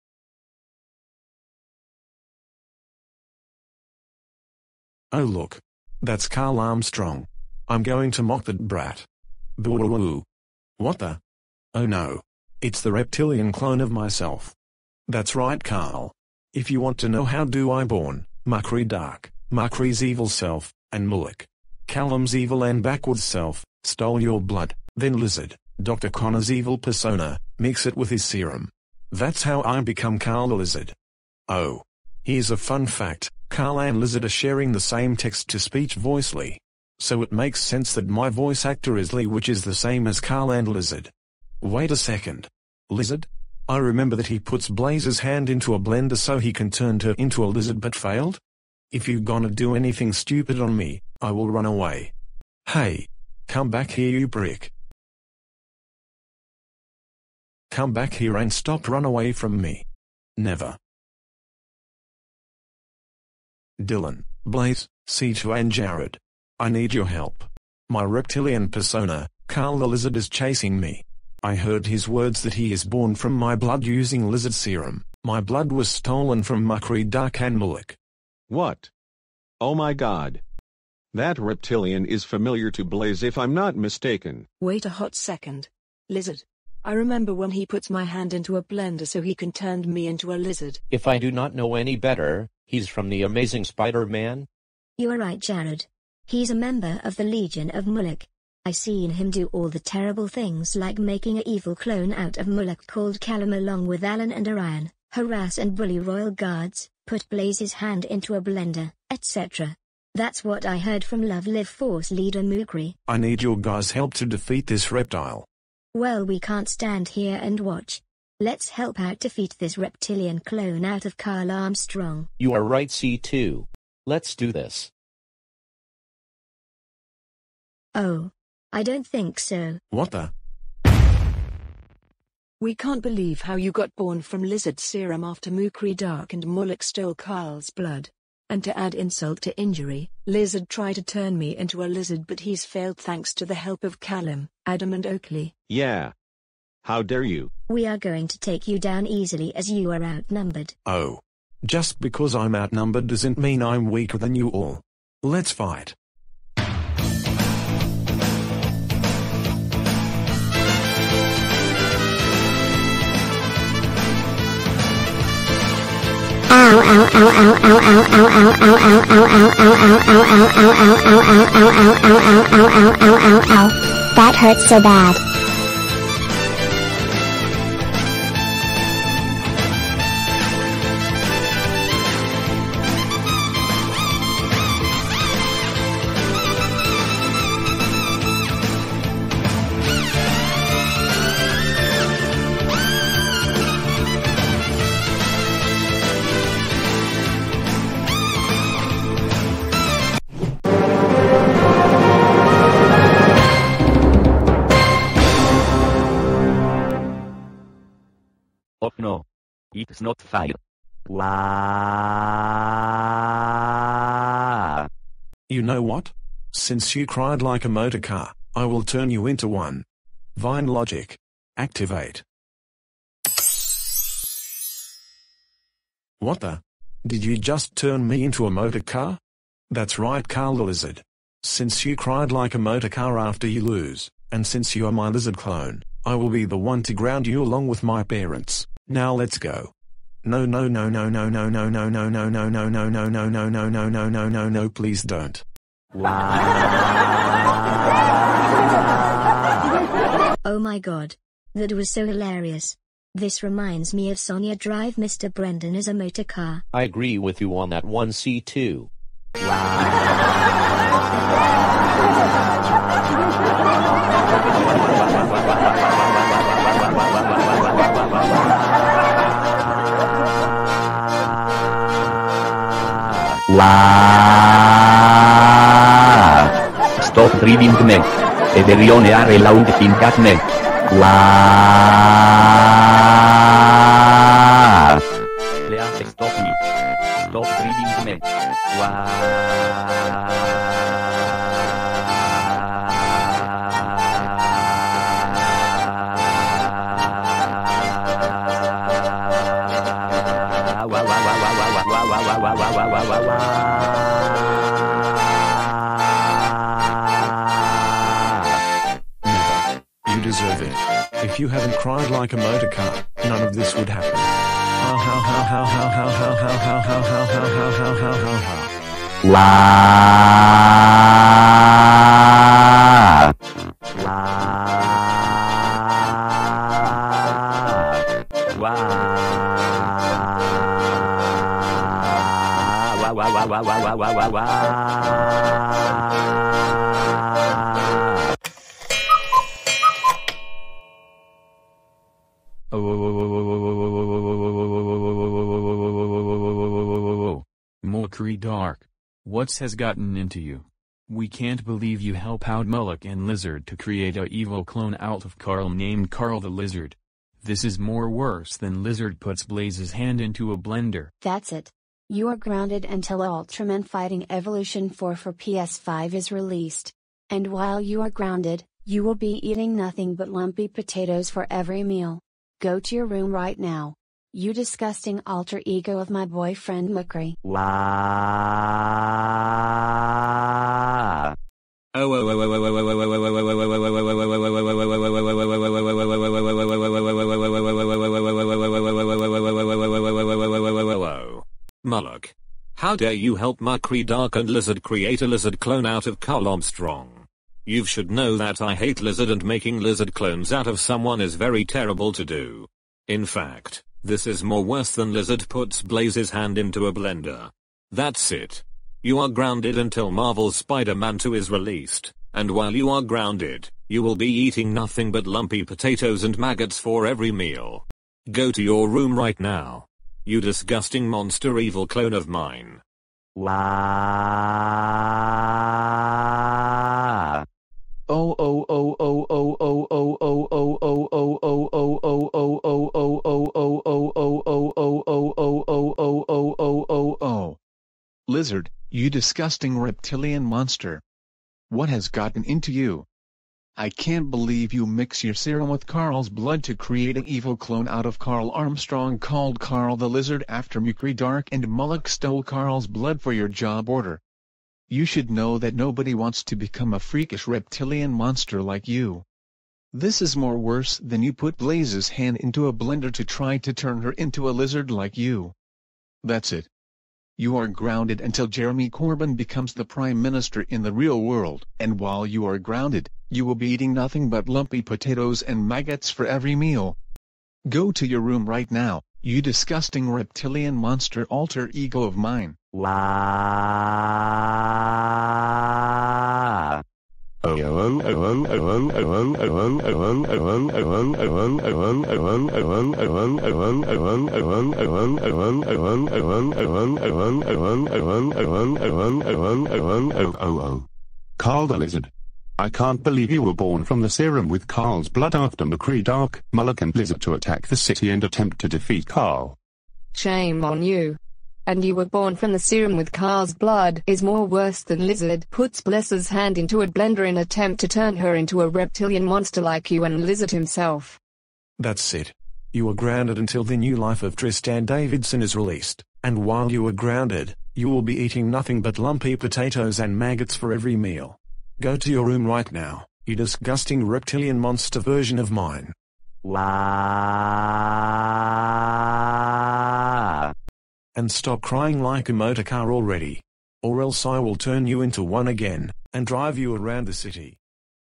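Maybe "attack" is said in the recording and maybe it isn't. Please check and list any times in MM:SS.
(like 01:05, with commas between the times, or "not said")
08:27.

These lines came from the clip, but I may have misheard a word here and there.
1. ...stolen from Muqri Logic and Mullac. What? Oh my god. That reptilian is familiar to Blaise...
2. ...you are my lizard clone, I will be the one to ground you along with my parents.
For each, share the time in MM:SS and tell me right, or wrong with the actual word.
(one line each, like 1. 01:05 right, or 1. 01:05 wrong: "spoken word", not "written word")
1. 01:15 wrong: "Dark", not "Logic"
2. 03:54 right.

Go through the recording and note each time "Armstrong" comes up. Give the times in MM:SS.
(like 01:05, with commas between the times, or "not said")
00:06, 02:01, 06:36.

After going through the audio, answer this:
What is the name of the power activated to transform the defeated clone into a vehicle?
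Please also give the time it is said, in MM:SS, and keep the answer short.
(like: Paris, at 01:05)
Vine Logic, at 03:40.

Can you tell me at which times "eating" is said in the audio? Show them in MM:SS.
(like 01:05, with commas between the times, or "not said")
06:09, 06:54, 07:53, 08:48.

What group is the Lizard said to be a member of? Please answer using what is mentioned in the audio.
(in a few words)
Legion of Mullac.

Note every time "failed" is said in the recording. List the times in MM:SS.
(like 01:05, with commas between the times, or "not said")
00:47, 02:22.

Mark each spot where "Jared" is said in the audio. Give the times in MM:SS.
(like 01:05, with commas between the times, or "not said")
01:05, 01:35.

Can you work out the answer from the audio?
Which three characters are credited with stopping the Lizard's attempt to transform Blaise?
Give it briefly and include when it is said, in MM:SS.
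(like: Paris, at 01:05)
Callum, Adam and Oakley, at 02:24.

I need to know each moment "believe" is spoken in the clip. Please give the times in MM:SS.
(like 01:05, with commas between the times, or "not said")
02:13, 05:51, 08:23.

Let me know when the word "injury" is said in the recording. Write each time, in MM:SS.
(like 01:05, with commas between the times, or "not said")
02:19.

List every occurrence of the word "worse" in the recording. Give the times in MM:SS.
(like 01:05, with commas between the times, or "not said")
05:58, 06:44, 07:40, 08:34.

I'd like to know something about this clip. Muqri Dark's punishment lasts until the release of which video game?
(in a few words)
Ultraman Fighting Evolution 4.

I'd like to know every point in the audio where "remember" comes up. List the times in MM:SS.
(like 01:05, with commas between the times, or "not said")
00:43, 01:26.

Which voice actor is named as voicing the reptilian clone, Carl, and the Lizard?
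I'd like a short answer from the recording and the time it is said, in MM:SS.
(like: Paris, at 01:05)
Lee, at 00:39.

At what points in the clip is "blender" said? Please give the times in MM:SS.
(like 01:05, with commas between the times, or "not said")
00:45, 01:28, 01:48, 06:00, 06:46, 07:42, 08:36.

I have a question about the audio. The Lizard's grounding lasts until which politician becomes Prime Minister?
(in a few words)
Jeremy Corbyn.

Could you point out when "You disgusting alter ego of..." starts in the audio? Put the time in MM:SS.
06:14.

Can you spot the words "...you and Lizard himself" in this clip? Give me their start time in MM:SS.
08:39.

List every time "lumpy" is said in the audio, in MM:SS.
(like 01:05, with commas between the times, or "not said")
06:10, 06:55, 07:54, 08:48.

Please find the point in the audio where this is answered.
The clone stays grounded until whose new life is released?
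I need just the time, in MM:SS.
08:44.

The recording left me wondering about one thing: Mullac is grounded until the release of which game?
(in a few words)
Marvel's Spider-Man 2.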